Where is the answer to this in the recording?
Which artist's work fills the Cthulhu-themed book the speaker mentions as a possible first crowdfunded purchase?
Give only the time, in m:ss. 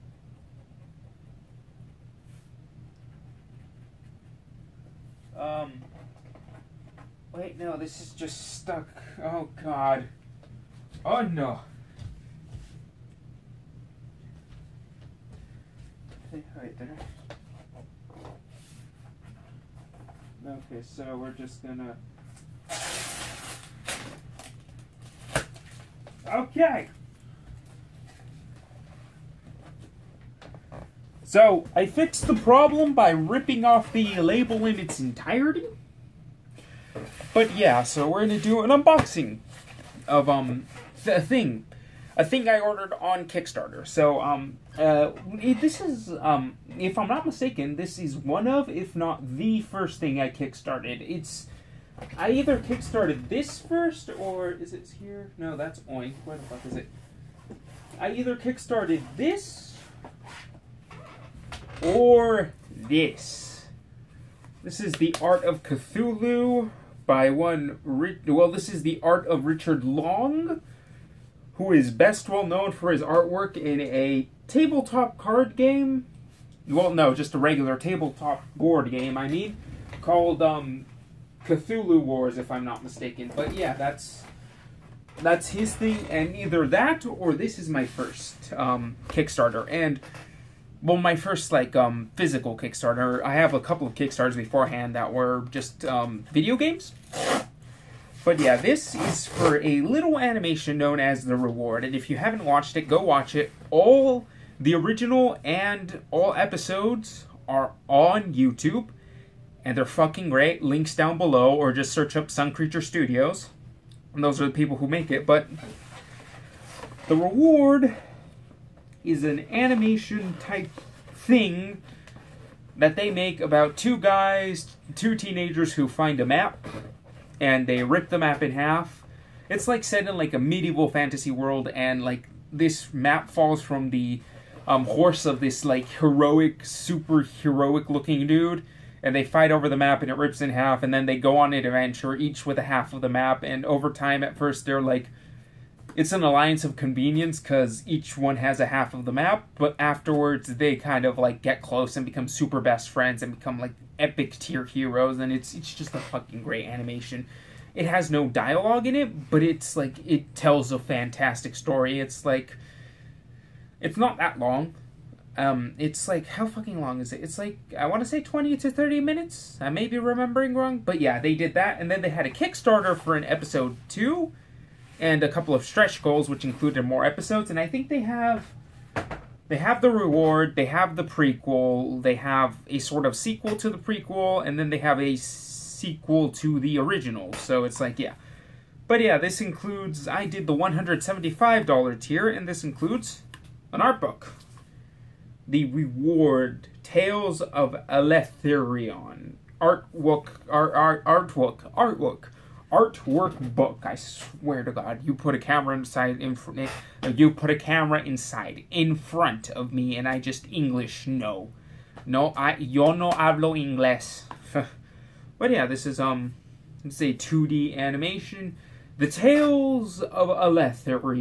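1:09.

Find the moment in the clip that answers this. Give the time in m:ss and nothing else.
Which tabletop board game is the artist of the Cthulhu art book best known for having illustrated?
1:21.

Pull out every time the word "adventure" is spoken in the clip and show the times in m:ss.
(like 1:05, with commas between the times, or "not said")
2:21.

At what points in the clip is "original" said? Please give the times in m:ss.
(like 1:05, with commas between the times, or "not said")
1:44, 3:06.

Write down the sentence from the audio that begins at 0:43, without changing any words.
So um uh this is um if I'm not mistaken, this is one of if not the first thing I kickstarted.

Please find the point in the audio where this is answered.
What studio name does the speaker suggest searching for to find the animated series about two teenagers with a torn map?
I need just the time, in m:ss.
1:52.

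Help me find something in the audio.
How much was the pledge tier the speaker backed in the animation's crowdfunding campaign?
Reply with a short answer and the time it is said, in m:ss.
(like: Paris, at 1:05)
$175, at 3:10.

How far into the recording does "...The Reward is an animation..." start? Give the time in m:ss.
1:57.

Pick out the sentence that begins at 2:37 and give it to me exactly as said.
It has no dialogue in it, but it's like it tells a fantastic story.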